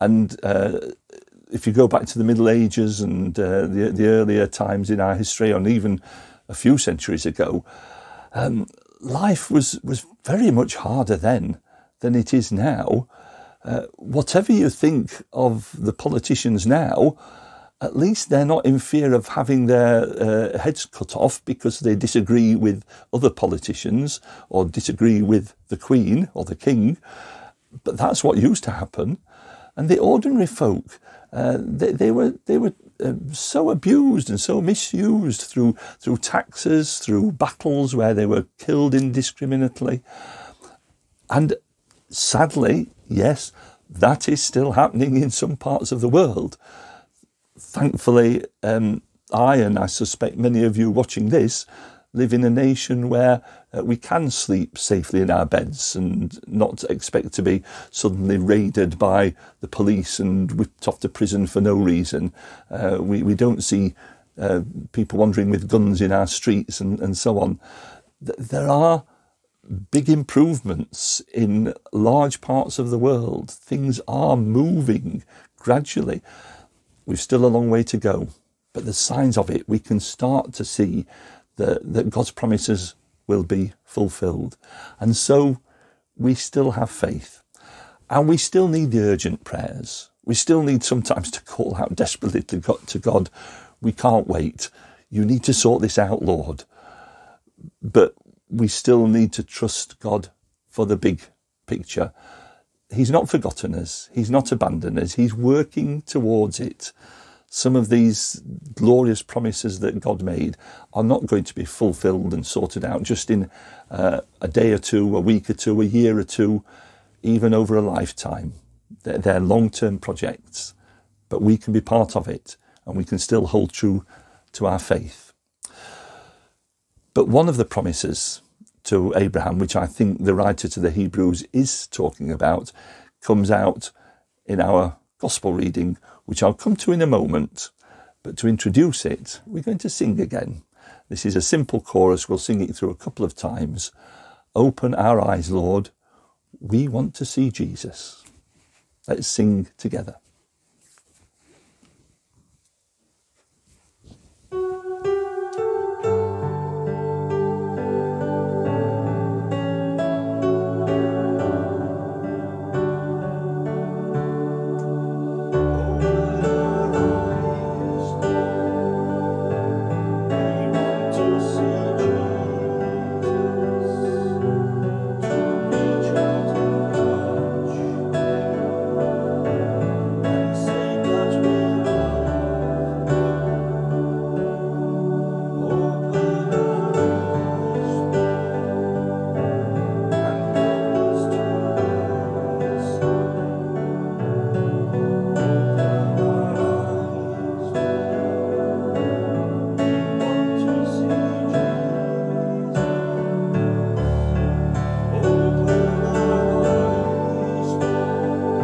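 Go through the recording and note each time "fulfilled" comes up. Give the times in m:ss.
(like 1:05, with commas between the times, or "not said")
1:23, 1:51.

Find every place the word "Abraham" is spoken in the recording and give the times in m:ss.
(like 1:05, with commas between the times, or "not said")
2:09.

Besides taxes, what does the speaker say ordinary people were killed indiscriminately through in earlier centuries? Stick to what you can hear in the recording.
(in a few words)
battles.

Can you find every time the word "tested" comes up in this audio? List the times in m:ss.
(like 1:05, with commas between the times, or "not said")
not said.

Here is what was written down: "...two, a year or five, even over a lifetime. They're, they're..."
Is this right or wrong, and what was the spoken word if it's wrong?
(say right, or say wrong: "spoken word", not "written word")
wrong: "two", not "five".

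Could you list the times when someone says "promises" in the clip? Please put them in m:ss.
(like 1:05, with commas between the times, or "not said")
1:22, 1:49, 2:07.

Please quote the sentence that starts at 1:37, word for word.
But we still need to trust God for the big picture.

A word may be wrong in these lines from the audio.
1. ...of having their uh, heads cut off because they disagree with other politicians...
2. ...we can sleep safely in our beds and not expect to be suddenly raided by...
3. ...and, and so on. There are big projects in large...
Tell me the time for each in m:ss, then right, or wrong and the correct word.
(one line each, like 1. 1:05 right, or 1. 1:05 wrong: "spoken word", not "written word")
1. 0:19 right
2. 0:53 right
3. 1:06 wrong: "improvements", not "projects".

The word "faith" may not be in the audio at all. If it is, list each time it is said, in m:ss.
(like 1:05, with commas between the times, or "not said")
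1:26, 2:04.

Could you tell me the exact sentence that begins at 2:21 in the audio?
This is a simple chorus, we'll sing it through a couple of times.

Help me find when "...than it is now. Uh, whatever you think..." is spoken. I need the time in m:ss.
0:12.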